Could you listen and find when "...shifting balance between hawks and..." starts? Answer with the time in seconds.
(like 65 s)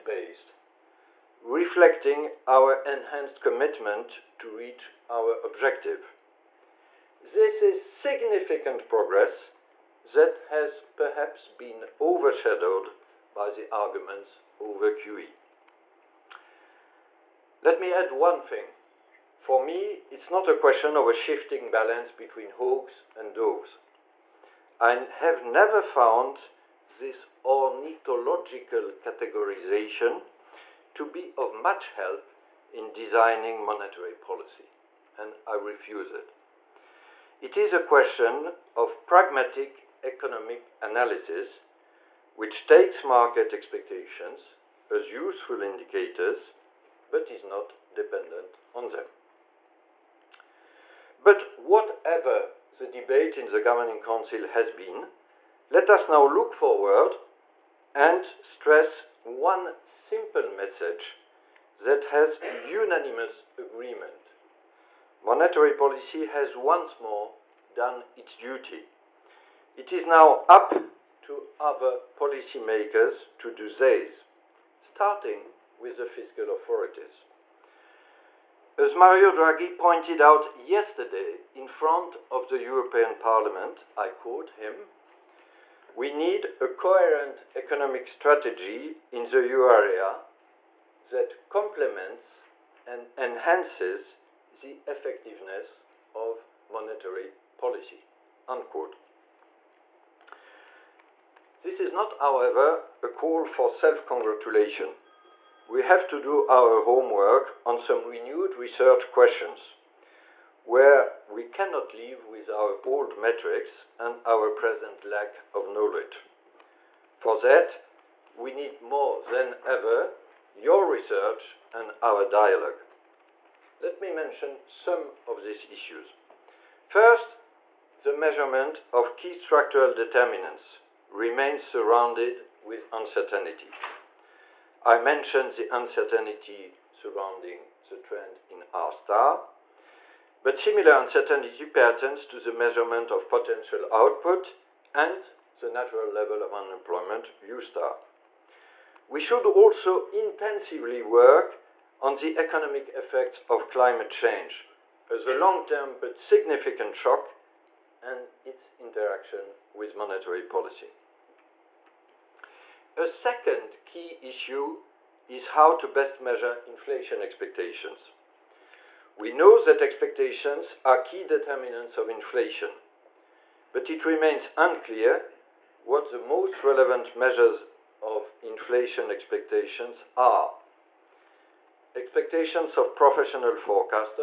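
21 s.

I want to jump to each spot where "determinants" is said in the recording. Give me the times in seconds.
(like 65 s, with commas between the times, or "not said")
129 s, 171 s.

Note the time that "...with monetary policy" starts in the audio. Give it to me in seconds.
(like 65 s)
159 s.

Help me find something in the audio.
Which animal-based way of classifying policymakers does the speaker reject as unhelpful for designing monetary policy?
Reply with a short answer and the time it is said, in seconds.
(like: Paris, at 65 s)
Ornithological categorization, at 27 s.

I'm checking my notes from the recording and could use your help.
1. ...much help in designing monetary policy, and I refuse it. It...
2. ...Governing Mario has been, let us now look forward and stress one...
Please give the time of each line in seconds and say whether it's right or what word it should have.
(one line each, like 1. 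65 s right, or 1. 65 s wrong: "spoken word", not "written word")
1. 31 s right
2. 53 s wrong: "Council", not "Mario".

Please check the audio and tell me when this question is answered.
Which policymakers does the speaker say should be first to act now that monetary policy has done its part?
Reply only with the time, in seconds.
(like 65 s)
76 s.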